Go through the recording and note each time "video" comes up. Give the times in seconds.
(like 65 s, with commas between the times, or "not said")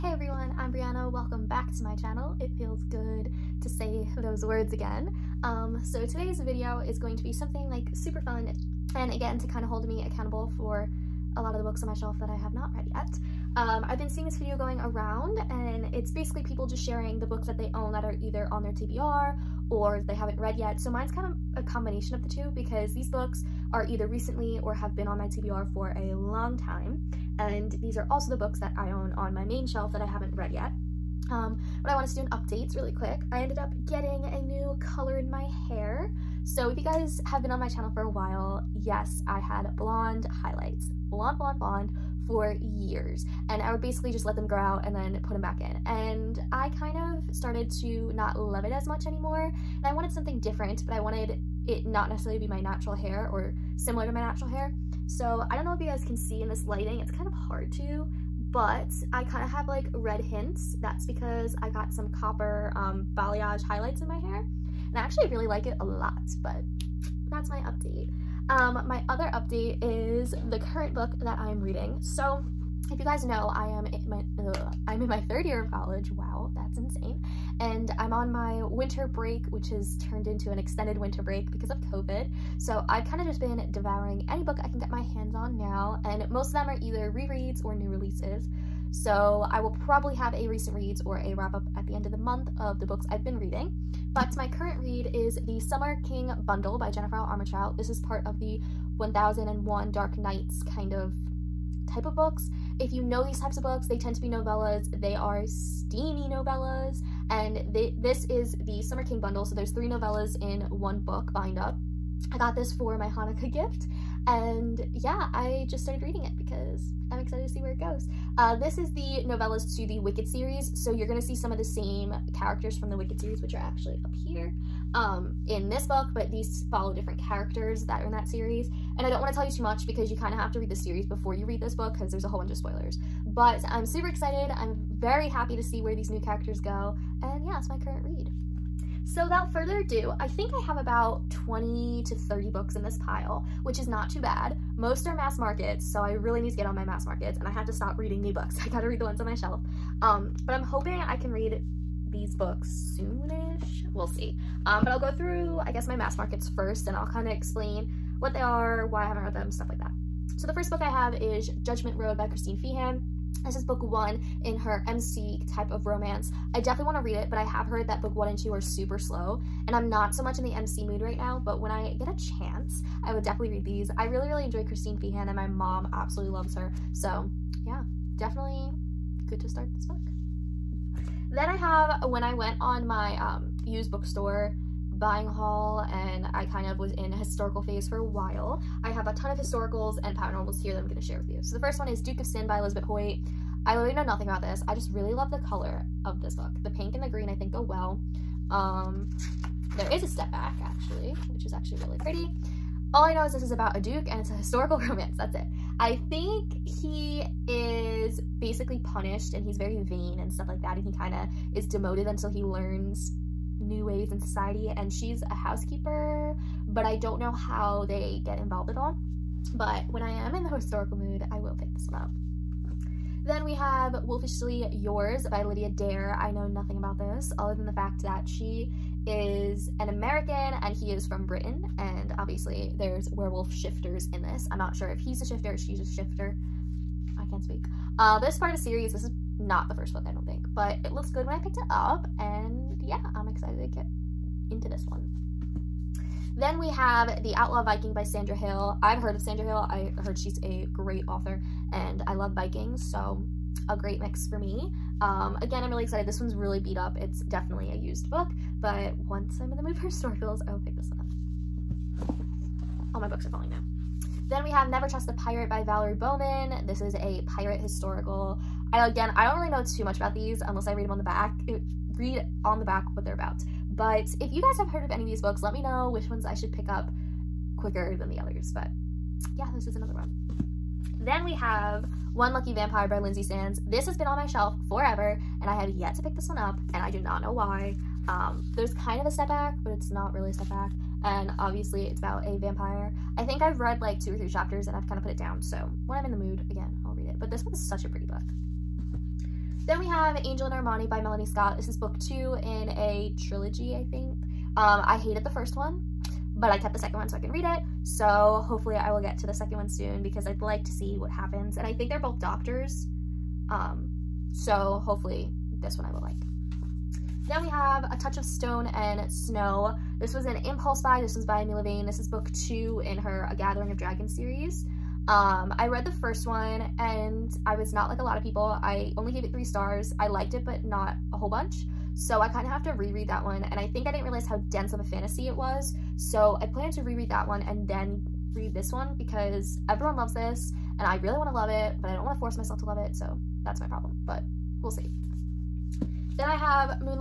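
6 s, 14 s.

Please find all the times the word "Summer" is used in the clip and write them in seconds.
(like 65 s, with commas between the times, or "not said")
95 s, 108 s.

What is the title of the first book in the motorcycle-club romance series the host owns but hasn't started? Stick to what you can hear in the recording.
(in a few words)
Judgment Road.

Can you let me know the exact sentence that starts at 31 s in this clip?
Um, but I want to do an update really quick.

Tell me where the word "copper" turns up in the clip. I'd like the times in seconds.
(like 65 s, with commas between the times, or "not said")
62 s.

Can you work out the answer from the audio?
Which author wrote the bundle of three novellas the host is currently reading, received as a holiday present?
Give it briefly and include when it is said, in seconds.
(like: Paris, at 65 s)
Jennifer Armentrout, at 96 s.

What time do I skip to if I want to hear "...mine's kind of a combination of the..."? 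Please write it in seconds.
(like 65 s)
20 s.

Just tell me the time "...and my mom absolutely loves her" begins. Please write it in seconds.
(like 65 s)
175 s.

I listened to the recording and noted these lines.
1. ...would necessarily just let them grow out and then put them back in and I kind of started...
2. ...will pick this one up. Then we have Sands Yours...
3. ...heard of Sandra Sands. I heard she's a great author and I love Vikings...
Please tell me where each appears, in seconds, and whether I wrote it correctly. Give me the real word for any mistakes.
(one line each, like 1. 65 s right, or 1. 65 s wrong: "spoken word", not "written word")
1. 43 s wrong: "basically", not "necessarily"
2. 221 s wrong: "Wolfishly", not "Sands"
3. 249 s wrong: "Hill", not "Sands".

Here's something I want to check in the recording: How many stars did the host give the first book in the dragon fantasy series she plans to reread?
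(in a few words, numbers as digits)
3.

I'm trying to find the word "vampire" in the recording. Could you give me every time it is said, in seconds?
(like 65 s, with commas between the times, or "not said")
282 s, 292 s.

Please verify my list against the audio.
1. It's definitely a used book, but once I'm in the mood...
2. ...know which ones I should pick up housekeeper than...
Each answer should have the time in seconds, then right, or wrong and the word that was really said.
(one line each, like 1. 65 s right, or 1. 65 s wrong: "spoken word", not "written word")
1. 257 s right
2. 275 s wrong: "quicker", not "housekeeper".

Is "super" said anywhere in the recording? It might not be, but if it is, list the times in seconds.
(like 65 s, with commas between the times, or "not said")
7 s, 133 s, 168 s.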